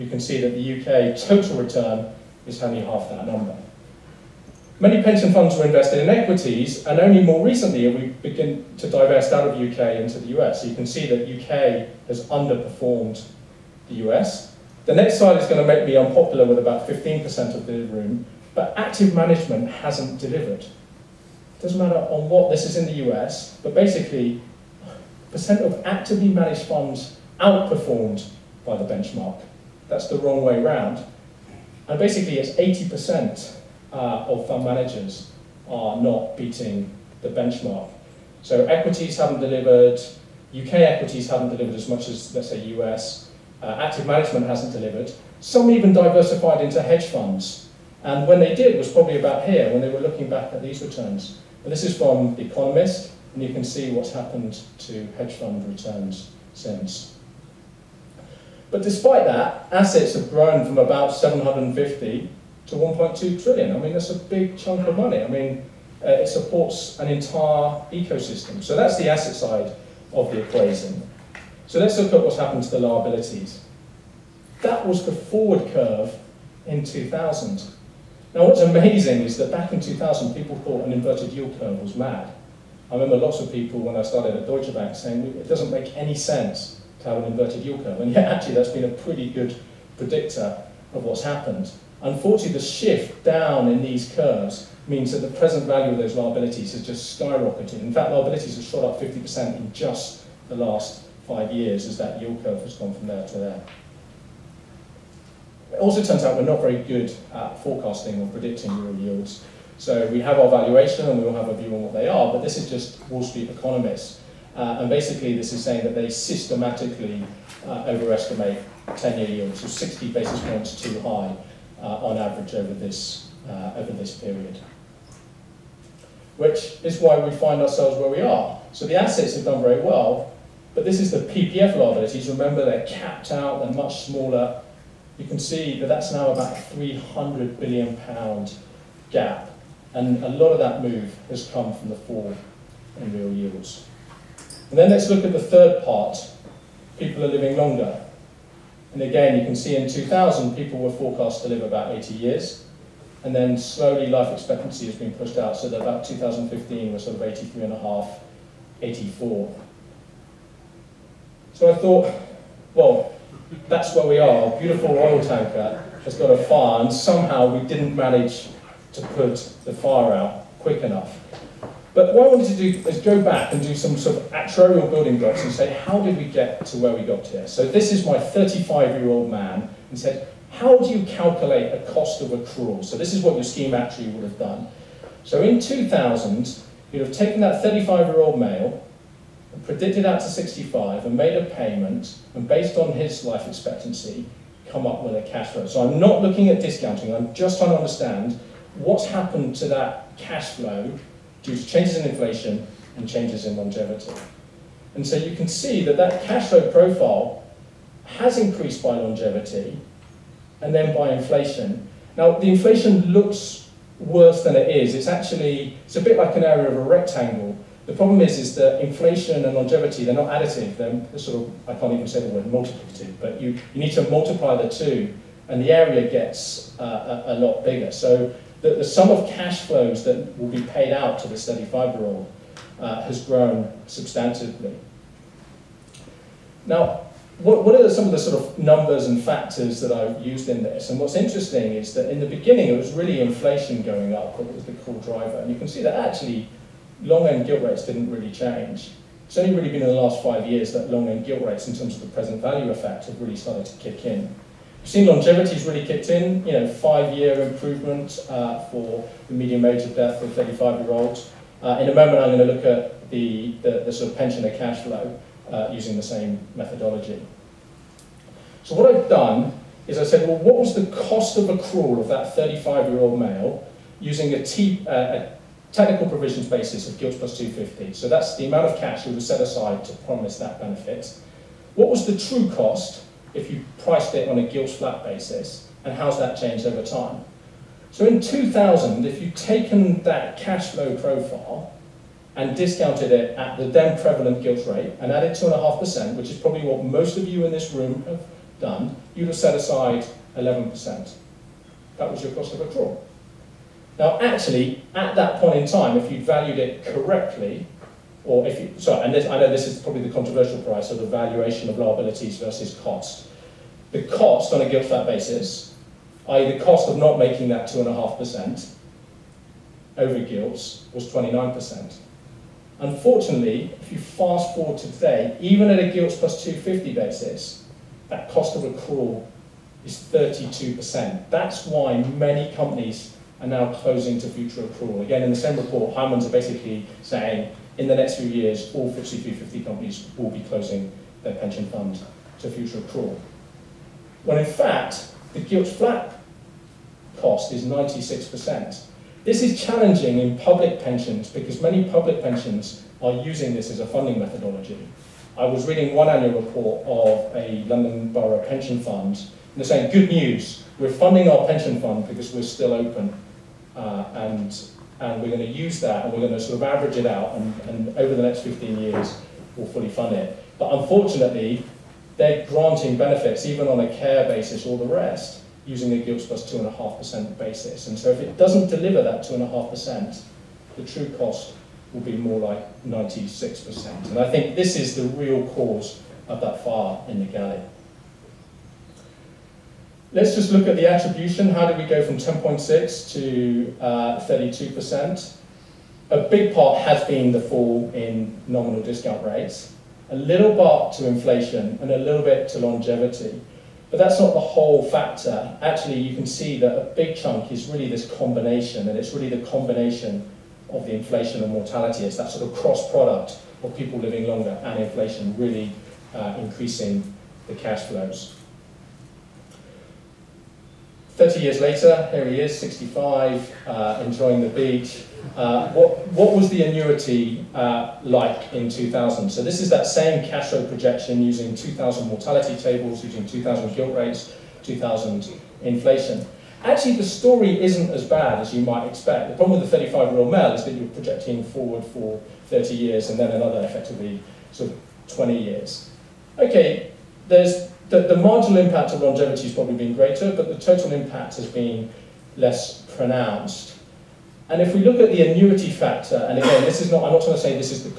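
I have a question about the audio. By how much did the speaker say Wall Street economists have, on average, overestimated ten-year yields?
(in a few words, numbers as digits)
60 basis points.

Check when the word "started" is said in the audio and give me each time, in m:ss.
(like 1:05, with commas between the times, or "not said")
1:24, 4:13.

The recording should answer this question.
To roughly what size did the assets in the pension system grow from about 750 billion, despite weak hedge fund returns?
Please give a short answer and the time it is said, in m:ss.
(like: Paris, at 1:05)
1.2 trillion, at 1:02.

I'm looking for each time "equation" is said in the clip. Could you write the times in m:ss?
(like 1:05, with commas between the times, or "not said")
1:10.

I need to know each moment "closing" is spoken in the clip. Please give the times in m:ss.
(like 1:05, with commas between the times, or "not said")
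5:33, 5:40.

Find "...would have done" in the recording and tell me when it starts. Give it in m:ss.
3:04.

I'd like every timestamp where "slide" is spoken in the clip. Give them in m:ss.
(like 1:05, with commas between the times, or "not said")
0:15.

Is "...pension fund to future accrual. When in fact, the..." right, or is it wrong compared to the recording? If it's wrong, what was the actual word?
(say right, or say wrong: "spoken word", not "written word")
right.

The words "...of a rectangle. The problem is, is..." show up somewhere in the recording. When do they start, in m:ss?
3:36.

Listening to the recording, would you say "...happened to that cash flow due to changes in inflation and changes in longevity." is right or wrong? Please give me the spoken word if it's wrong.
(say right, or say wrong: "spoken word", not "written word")
right.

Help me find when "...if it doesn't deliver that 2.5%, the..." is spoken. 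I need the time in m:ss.
6:18.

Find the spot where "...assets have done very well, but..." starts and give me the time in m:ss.
2:08.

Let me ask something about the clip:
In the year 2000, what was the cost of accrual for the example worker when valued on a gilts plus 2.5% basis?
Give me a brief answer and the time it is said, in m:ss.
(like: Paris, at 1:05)
11%, at 5:00.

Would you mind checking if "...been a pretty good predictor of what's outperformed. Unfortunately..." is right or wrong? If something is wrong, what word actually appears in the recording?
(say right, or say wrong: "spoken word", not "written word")
wrong: "happened", not "outperformed".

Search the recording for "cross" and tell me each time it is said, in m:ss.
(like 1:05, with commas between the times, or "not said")
6:52.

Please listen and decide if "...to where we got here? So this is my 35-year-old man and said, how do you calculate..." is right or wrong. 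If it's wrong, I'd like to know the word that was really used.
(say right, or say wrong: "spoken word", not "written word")
right.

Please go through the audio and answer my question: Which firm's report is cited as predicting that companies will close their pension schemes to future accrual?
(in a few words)
Hymans.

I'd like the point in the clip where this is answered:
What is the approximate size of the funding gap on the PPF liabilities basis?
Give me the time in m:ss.
2:16.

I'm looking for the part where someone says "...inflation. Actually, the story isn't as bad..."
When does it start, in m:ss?
7:15.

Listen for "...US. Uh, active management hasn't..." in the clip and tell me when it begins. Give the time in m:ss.
0:42.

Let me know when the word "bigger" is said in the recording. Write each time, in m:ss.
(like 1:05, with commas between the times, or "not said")
3:47.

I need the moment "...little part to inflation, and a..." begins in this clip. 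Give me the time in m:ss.
6:40.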